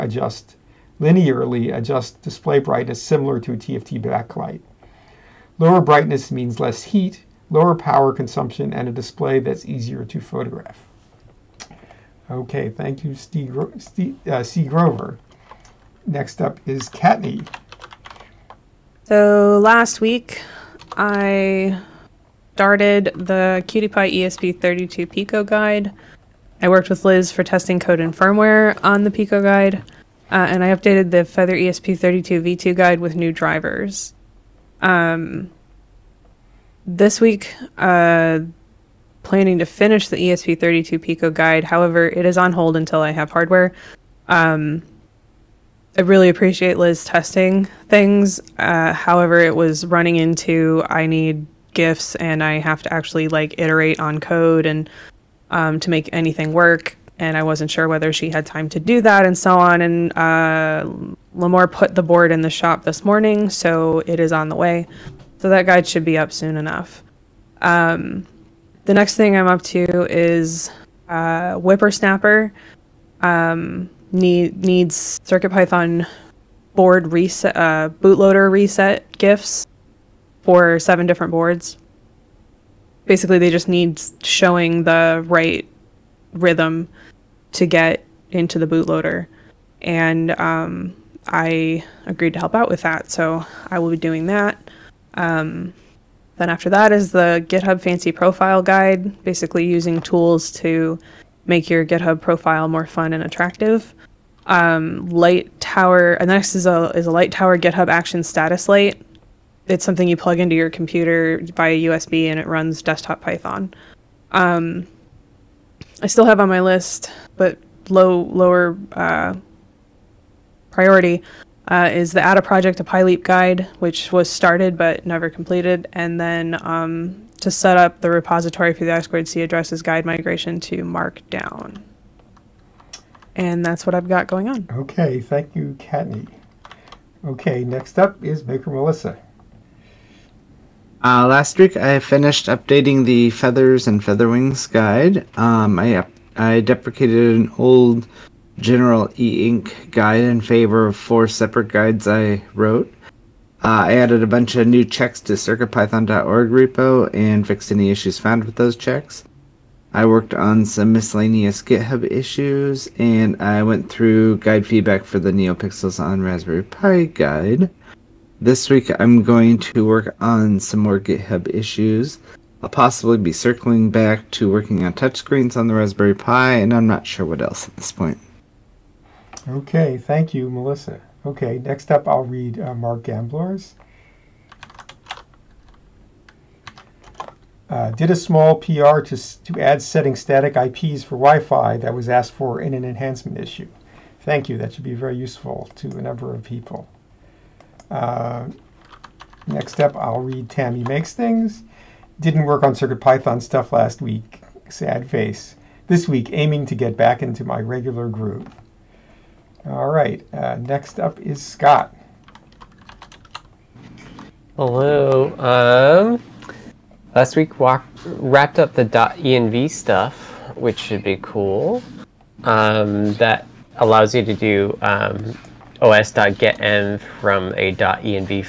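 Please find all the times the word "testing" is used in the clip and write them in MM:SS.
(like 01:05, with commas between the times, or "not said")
00:27, 00:47.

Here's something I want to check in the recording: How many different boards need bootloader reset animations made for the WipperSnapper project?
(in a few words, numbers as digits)
7.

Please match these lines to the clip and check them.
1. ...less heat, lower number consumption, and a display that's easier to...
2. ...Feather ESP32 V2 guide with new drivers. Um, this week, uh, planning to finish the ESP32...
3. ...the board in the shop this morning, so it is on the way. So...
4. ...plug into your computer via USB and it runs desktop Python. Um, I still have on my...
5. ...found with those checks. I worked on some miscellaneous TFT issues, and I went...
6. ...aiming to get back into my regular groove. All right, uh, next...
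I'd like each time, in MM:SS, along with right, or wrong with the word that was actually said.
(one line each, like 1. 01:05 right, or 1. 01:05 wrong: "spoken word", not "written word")
1. 00:06 wrong: "power", not "number"
2. 00:31 right
3. 01:01 right
4. 01:50 right
5. 02:38 wrong: "GitHub", not "TFT"
6. 03:26 right.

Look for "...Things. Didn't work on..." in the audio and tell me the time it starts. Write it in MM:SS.
03:21.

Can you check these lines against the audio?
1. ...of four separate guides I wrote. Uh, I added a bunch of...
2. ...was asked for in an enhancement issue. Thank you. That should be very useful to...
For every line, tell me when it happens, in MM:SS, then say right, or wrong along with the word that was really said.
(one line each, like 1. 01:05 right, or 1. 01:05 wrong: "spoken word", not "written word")
1. 02:30 right
2. 03:11 right.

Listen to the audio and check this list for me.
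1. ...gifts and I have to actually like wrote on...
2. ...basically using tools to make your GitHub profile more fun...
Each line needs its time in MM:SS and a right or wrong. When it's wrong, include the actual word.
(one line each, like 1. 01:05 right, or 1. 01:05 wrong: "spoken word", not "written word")
1. 00:51 wrong: "iterate", not "wrote"
2. 01:39 right.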